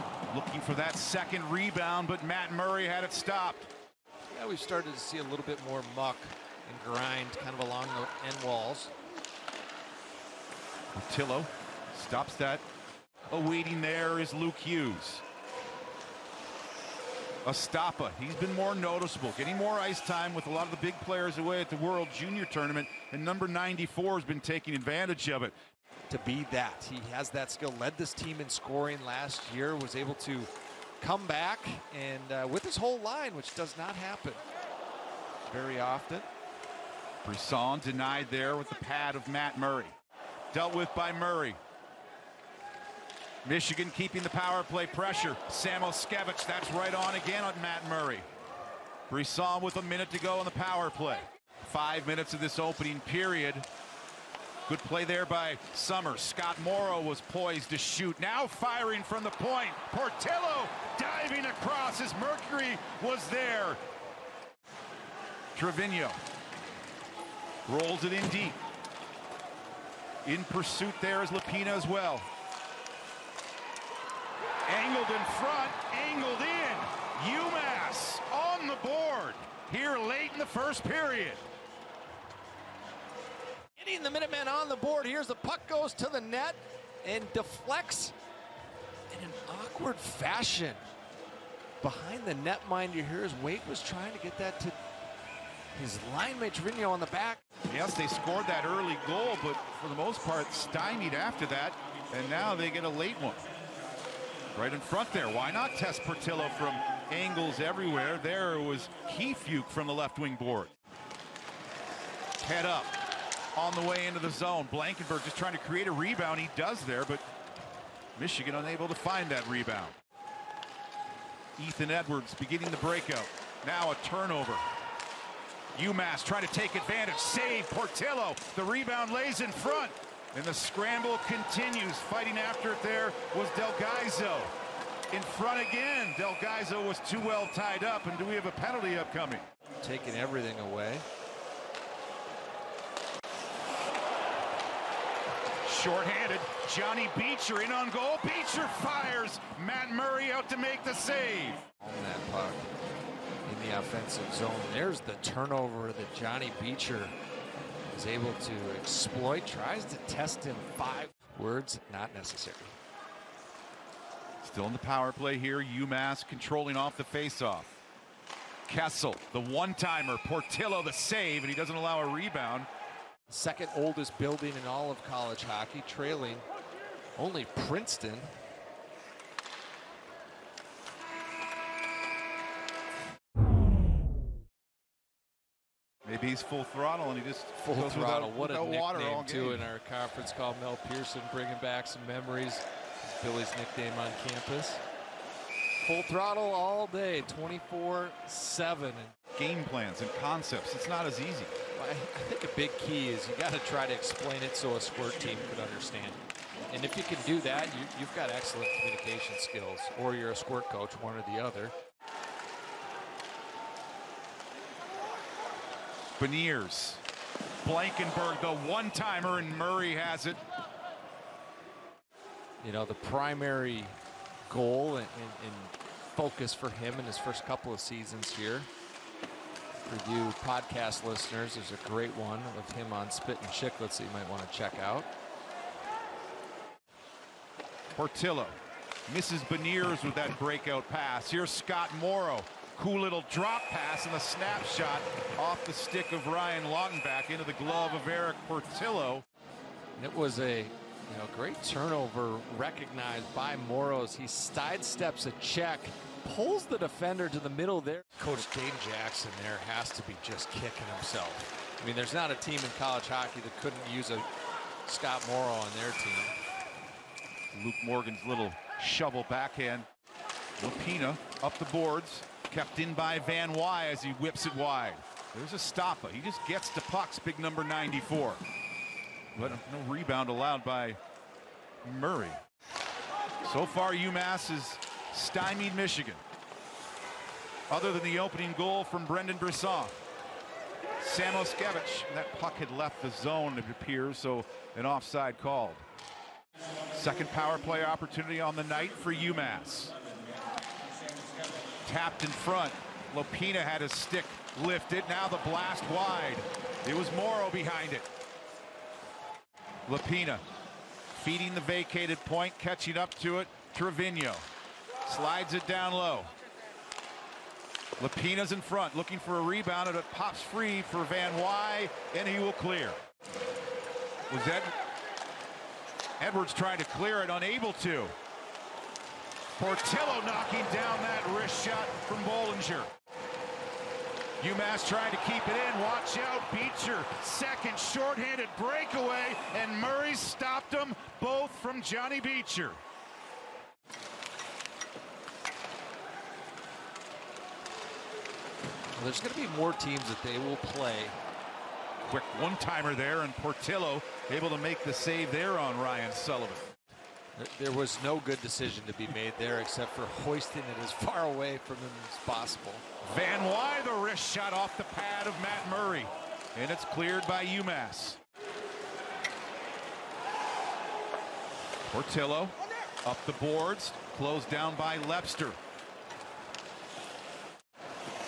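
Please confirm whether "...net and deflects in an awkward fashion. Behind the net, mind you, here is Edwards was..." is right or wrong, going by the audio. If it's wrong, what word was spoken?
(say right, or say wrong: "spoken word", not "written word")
wrong: "Wake", not "Edwards".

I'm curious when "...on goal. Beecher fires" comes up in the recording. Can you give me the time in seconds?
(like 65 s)
147 s.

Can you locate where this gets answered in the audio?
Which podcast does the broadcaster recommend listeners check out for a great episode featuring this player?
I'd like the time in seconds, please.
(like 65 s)
233 s.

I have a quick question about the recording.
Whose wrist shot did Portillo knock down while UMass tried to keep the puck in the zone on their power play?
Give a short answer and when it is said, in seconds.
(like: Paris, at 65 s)
Bohlinger, at 332 s.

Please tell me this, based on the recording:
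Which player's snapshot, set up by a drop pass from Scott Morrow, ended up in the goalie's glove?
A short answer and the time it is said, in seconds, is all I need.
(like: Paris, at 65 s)
Ryan Longback, at 246 s.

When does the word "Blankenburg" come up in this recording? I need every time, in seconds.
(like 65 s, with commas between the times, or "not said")
114 s, 217 s.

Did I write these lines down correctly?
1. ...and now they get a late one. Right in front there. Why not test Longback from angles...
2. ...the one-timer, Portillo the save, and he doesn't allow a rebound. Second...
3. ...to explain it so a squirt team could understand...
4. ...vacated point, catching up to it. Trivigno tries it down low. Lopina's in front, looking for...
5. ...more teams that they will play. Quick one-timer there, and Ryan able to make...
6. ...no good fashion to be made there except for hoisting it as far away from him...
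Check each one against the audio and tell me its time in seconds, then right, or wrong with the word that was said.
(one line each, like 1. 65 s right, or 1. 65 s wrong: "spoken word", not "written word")
1. 102 s wrong: "Portillo", not "Longback"
2. 169 s right
3. 203 s right
4. 311 s wrong: "slides", not "tries"
5. 349 s wrong: "Portillo", not "Ryan"
6. 358 s wrong: "decision", not "fashion".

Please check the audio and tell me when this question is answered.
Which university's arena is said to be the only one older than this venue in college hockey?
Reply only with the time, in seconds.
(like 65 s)
177 s.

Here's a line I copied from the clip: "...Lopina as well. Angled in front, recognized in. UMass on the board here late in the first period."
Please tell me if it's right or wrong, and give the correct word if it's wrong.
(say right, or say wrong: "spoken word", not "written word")
wrong: "angled", not "recognized".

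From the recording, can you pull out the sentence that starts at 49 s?
Brisson with a minute to go on the power play.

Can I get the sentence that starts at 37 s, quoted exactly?
Brisson denied there with the pad of Matt Murray.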